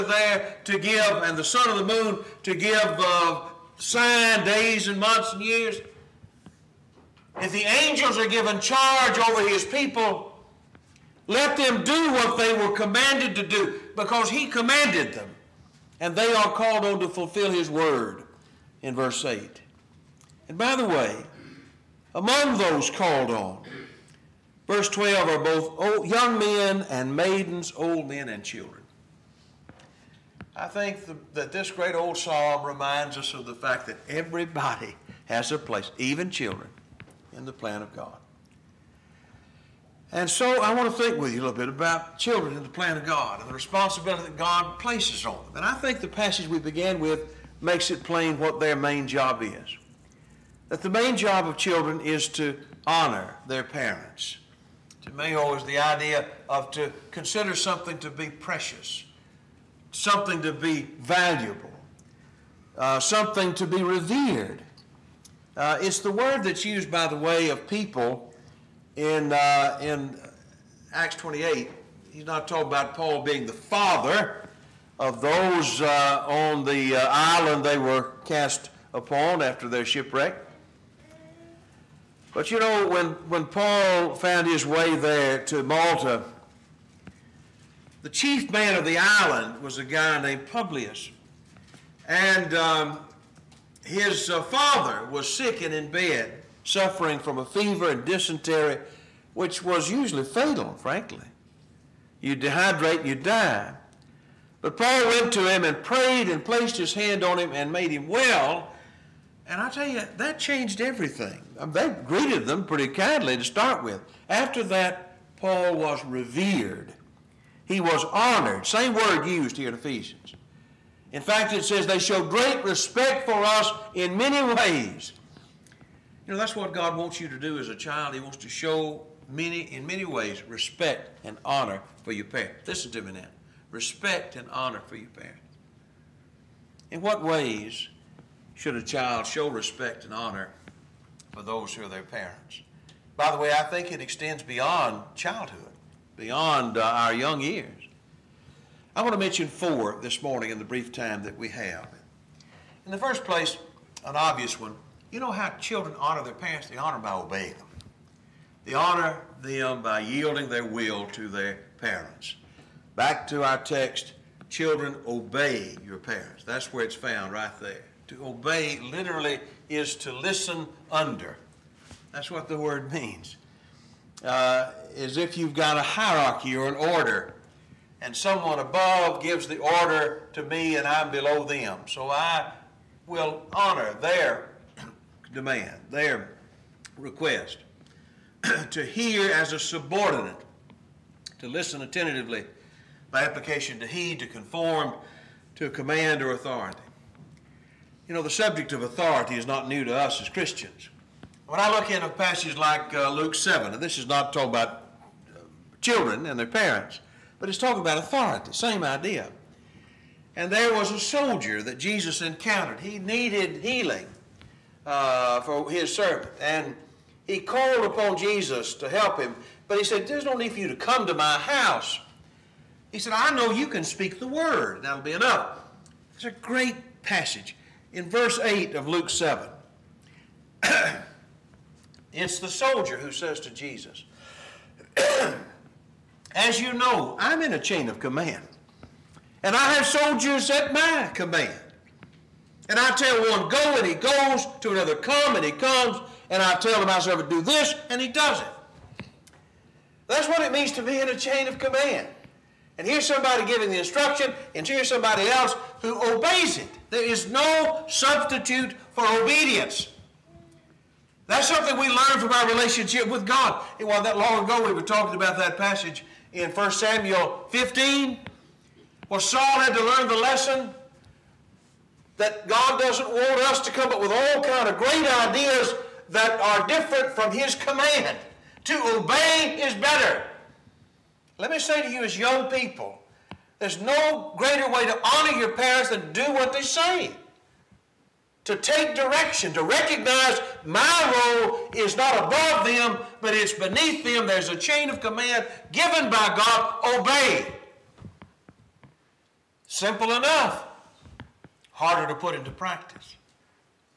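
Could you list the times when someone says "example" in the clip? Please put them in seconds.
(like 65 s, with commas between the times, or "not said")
not said.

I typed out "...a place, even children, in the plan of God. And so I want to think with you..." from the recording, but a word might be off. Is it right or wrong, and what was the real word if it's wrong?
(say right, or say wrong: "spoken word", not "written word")
right.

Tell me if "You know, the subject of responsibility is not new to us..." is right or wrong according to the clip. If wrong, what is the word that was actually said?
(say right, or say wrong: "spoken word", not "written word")
wrong: "authority", not "responsibility".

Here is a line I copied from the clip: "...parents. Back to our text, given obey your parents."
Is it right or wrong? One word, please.
wrong.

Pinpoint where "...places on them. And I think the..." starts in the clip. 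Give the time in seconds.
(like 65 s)
44 s.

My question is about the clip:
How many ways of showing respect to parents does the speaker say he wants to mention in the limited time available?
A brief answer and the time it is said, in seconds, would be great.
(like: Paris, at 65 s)
4, at 149 s.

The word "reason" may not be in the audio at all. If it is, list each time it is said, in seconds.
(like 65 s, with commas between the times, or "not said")
not said.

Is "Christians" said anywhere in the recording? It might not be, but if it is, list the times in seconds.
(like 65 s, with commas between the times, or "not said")
200 s.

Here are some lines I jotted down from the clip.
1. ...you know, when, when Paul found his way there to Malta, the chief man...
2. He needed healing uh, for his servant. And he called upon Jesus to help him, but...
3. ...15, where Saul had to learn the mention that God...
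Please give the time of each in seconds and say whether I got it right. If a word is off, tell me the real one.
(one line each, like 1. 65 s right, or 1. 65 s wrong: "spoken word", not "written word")
1. 82 s right
2. 212 s right
3. 267 s wrong: "lesson", not "mention".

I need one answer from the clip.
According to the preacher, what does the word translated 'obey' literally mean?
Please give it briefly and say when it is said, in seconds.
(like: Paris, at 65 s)
to listen under, at 169 s.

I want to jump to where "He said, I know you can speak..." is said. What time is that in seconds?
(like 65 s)
222 s.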